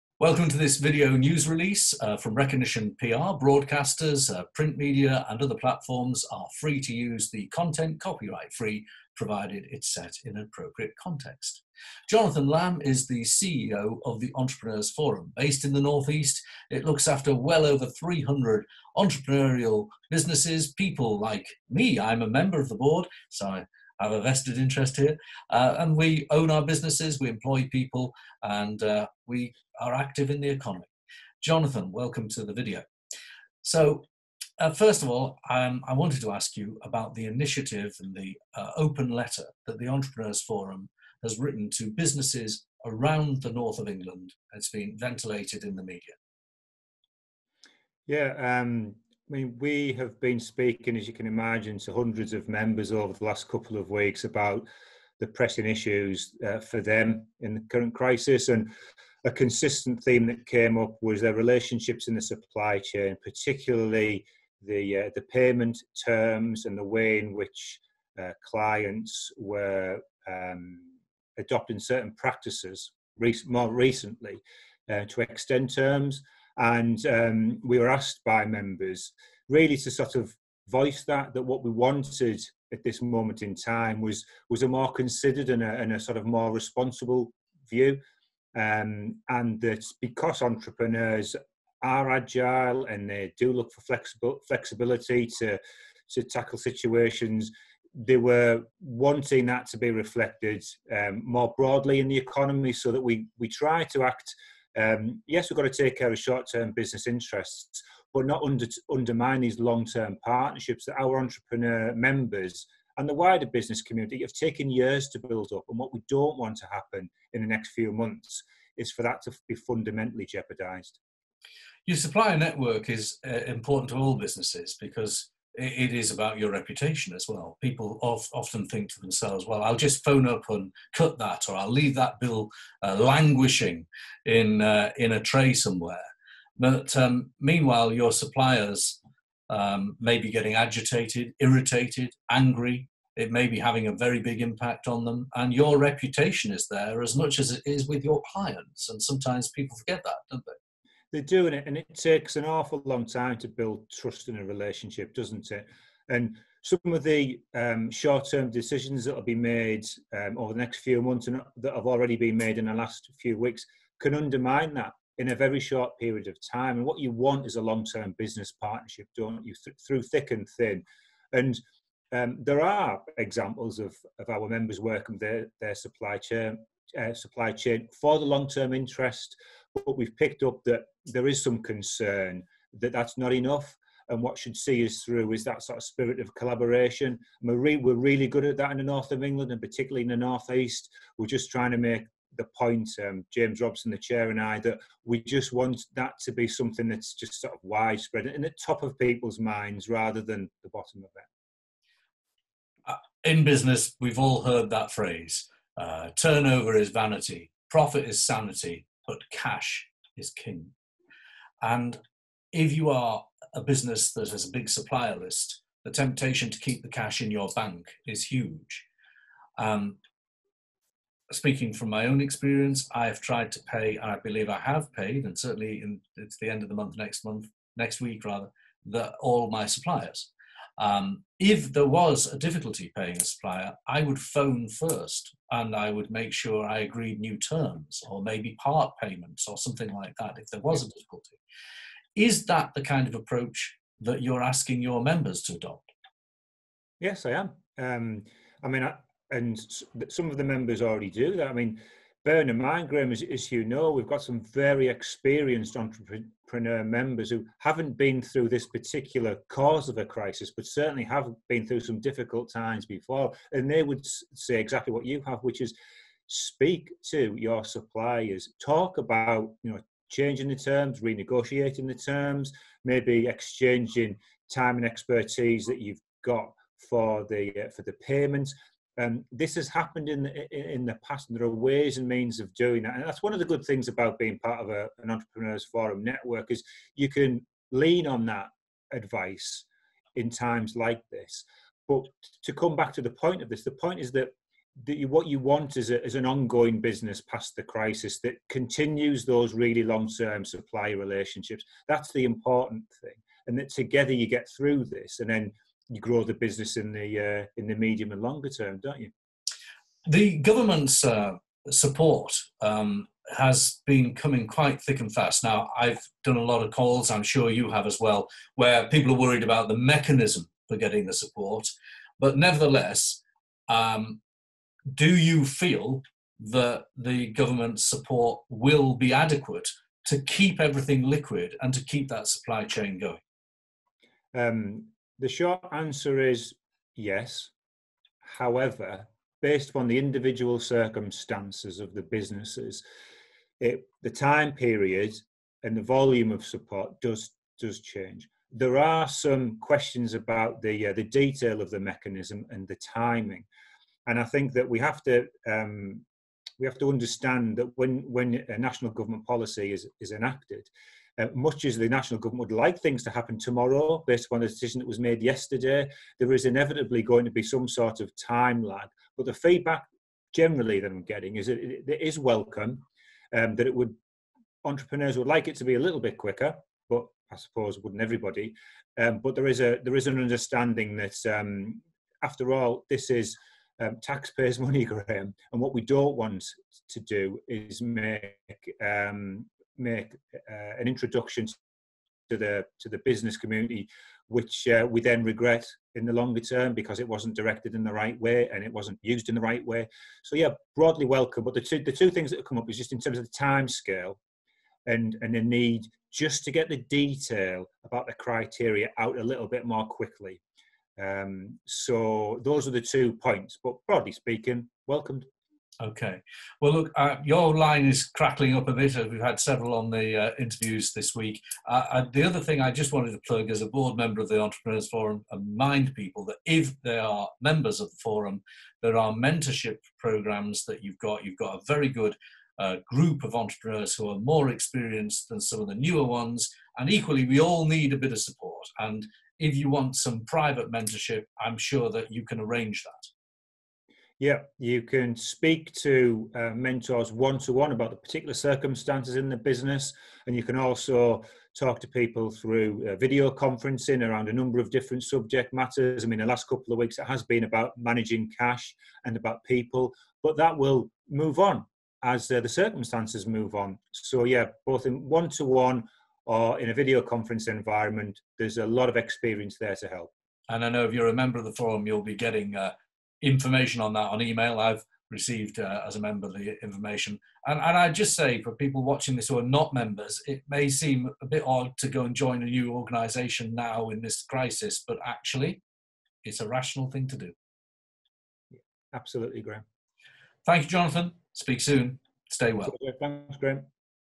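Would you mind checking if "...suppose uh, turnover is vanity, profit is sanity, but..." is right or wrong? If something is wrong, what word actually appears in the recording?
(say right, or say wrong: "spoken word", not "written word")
wrong: "phrase", not "suppose".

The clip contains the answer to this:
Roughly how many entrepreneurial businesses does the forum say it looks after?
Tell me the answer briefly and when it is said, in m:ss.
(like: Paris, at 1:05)
300, at 0:17.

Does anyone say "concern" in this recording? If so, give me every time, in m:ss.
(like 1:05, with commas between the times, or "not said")
3:01.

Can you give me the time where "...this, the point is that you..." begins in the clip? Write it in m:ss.
4:53.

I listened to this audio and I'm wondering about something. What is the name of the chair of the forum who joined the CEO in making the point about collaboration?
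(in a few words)
James Robson.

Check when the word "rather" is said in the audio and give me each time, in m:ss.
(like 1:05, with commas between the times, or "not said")
3:19, 3:48.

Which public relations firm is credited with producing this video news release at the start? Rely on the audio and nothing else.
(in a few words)
Recognition PR.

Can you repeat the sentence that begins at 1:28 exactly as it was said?
Um, and that because entrepreneurs are agile and they do look for flexible flexibility to to tackle situations.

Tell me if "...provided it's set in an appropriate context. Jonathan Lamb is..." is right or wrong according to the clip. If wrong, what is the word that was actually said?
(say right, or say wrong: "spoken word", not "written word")
right.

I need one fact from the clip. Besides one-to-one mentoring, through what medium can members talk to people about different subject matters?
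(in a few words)
video conferencing.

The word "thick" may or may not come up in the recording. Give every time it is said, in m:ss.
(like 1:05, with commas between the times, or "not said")
2:50, 5:14.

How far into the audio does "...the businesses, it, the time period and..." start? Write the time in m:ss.
5:41.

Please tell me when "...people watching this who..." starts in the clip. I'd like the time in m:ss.
7:58.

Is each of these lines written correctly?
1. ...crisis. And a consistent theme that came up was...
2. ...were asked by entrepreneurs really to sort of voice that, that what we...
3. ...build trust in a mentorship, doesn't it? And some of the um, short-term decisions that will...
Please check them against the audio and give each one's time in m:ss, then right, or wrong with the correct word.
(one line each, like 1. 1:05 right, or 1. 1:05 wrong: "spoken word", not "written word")
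1. 0:57 right
2. 1:17 wrong: "members", not "entrepreneurs"
3. 2:33 wrong: "relationship", not "mentorship".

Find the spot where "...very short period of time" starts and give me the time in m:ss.
2:45.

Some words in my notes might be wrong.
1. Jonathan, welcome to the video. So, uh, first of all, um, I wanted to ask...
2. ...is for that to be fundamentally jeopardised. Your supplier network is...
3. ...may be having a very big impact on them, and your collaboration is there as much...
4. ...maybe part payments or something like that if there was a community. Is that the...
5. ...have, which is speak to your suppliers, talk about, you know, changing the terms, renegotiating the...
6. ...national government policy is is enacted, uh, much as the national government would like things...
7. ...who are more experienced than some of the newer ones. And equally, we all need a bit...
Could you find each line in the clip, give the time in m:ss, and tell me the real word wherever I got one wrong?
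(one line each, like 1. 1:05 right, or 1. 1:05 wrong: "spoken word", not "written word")
1. 0:31 right
2. 1:58 right
3. 2:23 wrong: "reputation", not "collaboration"
4. 3:58 wrong: "difficulty", not "community"
5. 4:25 right
6. 5:58 right
7. 7:13 right.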